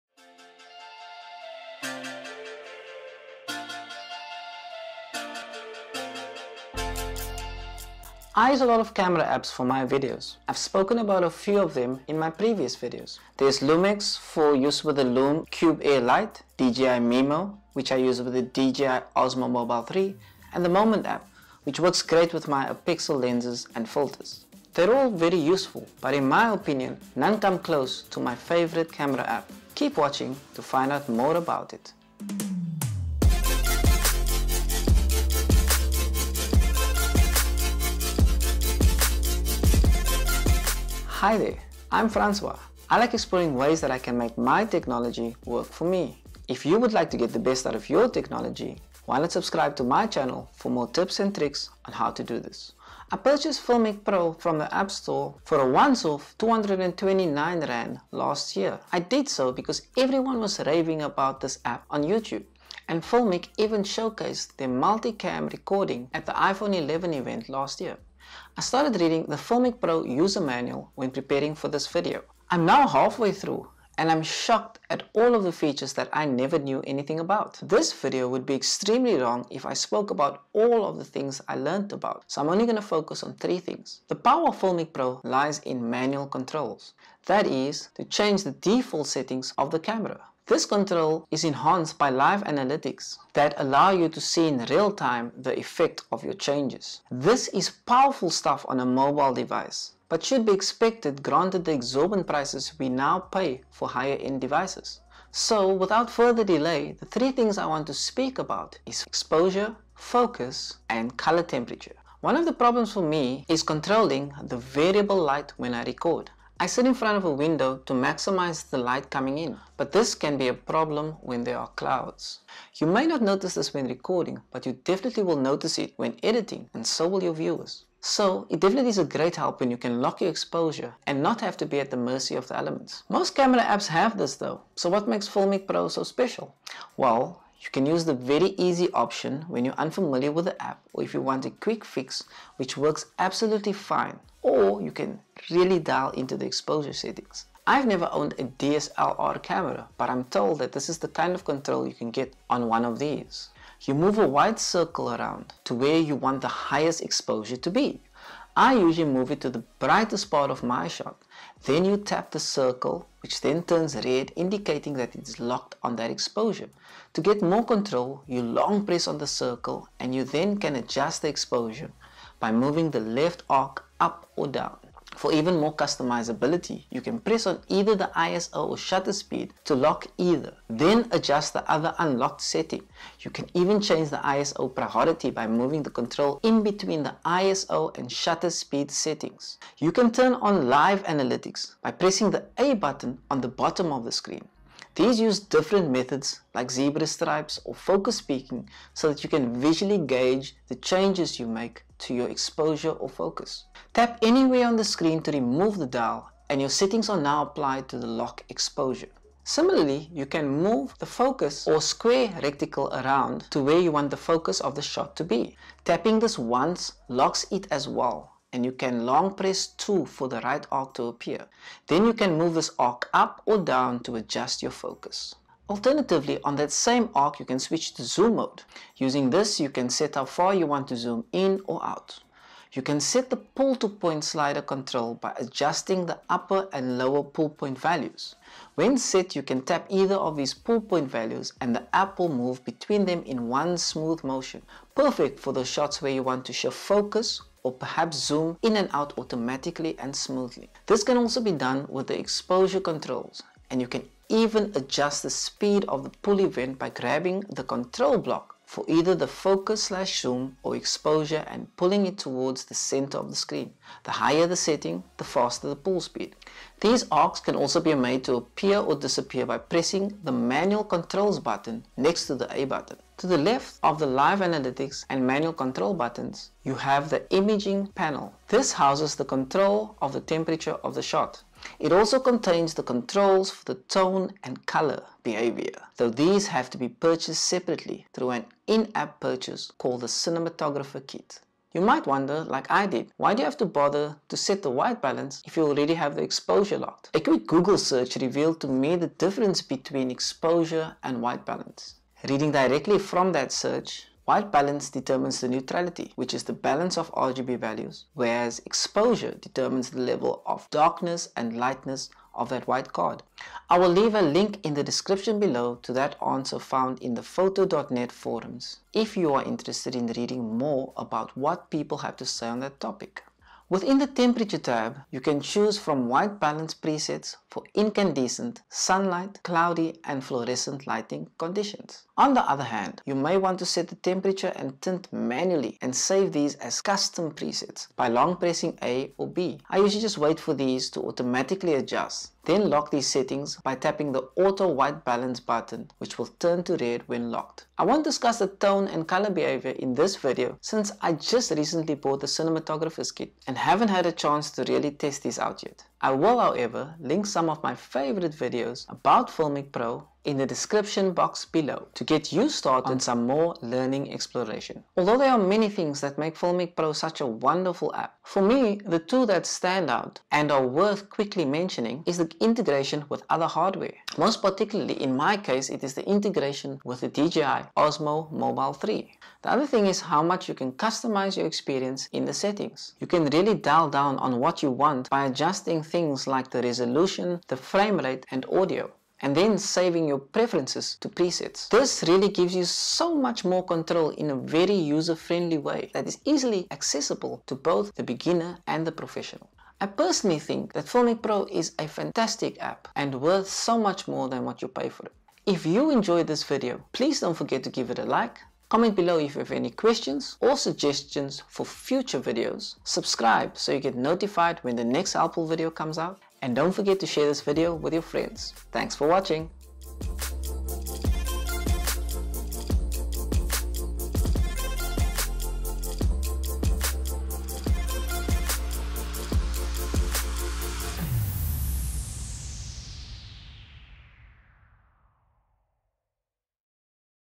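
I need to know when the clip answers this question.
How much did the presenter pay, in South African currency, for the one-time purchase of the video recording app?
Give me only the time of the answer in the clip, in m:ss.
0:56.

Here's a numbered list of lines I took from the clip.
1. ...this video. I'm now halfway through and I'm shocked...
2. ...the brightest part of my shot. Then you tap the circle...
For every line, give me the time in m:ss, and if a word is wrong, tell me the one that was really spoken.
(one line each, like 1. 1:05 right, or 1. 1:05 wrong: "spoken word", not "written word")
1. 1:11 right
2. 2:39 right.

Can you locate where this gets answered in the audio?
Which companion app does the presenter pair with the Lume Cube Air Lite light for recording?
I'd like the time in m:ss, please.
0:13.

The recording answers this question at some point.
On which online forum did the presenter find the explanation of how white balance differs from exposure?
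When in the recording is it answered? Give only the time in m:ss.
5:17.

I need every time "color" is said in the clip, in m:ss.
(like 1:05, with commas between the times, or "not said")
1:51, 4:44, 5:49.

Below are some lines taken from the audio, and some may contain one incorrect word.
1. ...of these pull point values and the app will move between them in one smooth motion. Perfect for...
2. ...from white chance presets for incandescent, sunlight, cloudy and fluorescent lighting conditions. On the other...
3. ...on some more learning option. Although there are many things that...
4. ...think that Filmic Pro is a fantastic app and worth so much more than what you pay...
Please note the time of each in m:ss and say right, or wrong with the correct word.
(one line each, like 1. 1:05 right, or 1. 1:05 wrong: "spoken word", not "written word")
1. 4:00 right
2. 5:25 wrong: "balance", not "chance"
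3. 6:02 wrong: "exploration", not "option"
4. 6:40 right.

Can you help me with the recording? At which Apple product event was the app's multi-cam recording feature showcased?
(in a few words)
iPhone 11 event.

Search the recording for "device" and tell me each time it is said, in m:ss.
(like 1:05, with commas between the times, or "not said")
1:39, 1:44.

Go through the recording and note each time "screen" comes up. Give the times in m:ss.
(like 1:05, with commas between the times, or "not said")
3:14, 3:24, 4:23.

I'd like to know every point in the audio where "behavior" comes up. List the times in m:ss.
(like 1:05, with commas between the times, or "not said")
4:45, 5:49.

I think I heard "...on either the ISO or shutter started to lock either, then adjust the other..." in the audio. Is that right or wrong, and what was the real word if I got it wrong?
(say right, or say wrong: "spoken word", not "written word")
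wrong: "speed", not "started".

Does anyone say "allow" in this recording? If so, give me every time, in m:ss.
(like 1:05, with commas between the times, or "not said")
1:33.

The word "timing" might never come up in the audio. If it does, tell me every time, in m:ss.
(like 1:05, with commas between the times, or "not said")
not said.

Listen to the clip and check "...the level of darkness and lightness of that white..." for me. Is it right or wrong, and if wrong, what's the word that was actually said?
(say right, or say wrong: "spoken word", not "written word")
right.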